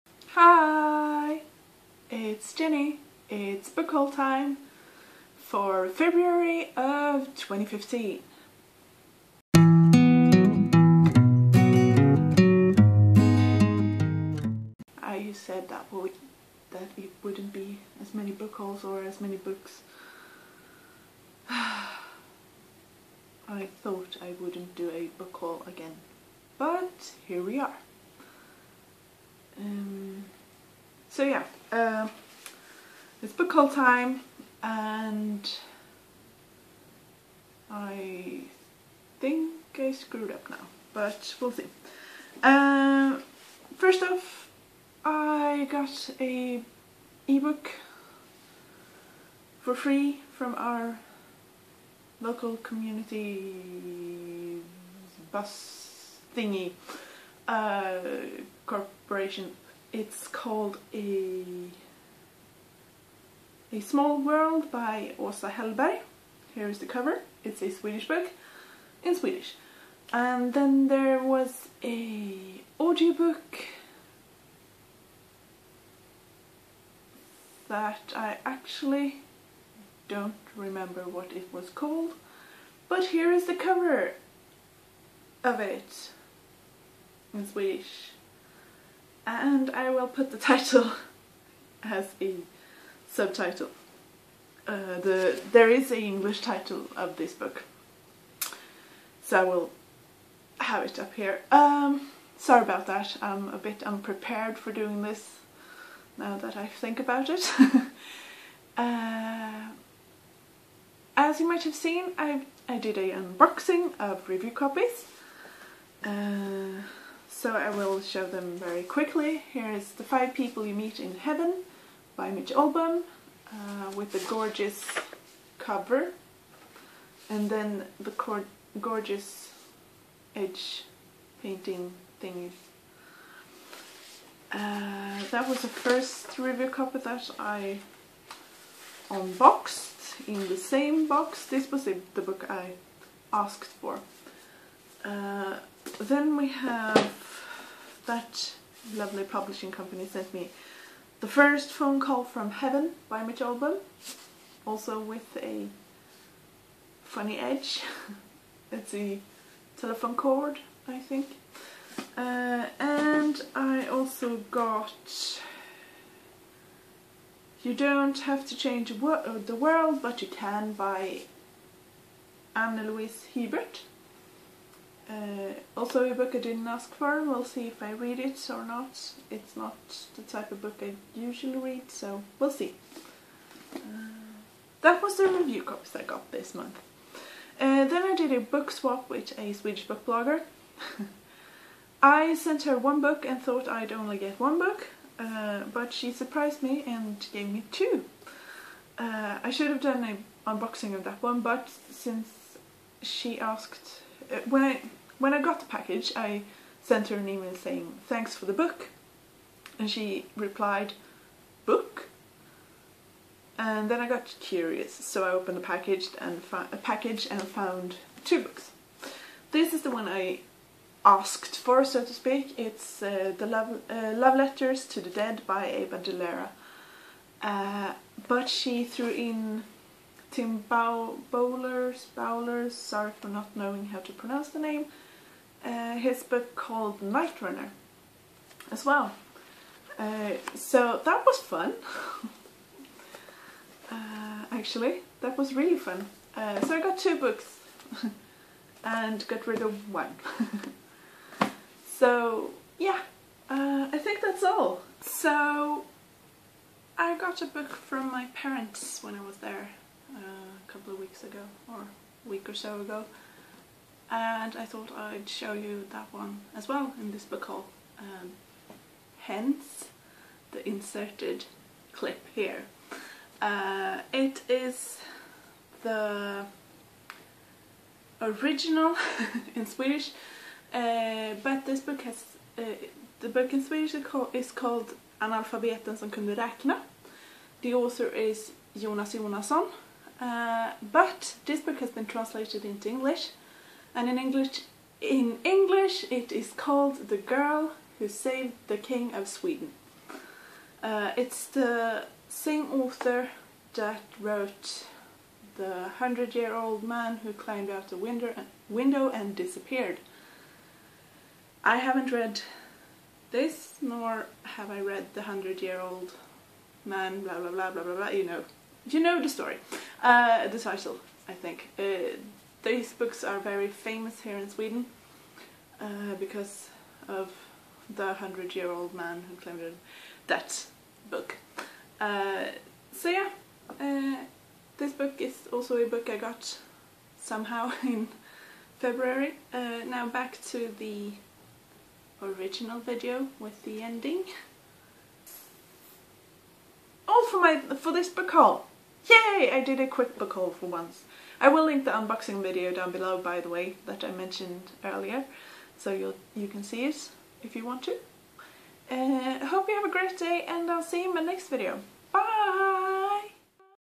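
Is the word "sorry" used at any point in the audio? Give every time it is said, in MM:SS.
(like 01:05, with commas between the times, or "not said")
01:42, 03:52.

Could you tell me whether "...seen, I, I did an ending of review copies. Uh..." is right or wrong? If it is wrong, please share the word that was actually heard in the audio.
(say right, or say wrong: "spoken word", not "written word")
wrong: "unboxing", not "ending".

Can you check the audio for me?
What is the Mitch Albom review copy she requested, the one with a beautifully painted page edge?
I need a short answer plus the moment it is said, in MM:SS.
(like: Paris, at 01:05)
The Five People You Meet in Heaven, at 01:59.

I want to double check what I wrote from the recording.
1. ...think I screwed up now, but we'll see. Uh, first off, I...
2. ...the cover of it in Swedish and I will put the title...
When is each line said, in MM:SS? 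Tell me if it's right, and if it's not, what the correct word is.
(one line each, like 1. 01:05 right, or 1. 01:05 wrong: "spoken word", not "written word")
1. 00:39 right
2. 01:23 right.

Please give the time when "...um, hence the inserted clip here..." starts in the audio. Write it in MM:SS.
04:27.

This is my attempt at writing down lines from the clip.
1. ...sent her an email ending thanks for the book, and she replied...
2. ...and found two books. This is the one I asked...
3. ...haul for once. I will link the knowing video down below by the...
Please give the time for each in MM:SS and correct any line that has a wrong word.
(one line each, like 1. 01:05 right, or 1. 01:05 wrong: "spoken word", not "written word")
1. 03:26 wrong: "saying", not "ending"
2. 03:37 right
3. 05:50 wrong: "unboxing", not "knowing".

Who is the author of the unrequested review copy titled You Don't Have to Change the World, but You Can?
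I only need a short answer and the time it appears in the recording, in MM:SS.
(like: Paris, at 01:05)
Anna Louise Hebert, at 02:52.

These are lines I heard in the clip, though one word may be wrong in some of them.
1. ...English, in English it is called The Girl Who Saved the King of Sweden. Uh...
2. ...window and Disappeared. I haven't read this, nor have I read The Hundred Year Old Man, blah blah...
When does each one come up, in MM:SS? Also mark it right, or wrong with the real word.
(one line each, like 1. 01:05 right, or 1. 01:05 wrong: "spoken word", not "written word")
1. 04:54 right
2. 05:08 right.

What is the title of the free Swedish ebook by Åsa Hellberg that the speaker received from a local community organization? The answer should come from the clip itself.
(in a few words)
A Small World.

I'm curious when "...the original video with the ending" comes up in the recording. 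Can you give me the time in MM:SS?
05:40.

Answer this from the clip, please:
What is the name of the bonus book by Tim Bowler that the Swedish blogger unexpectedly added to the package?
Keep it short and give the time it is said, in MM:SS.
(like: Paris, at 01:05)
Night Runner, at 03:57.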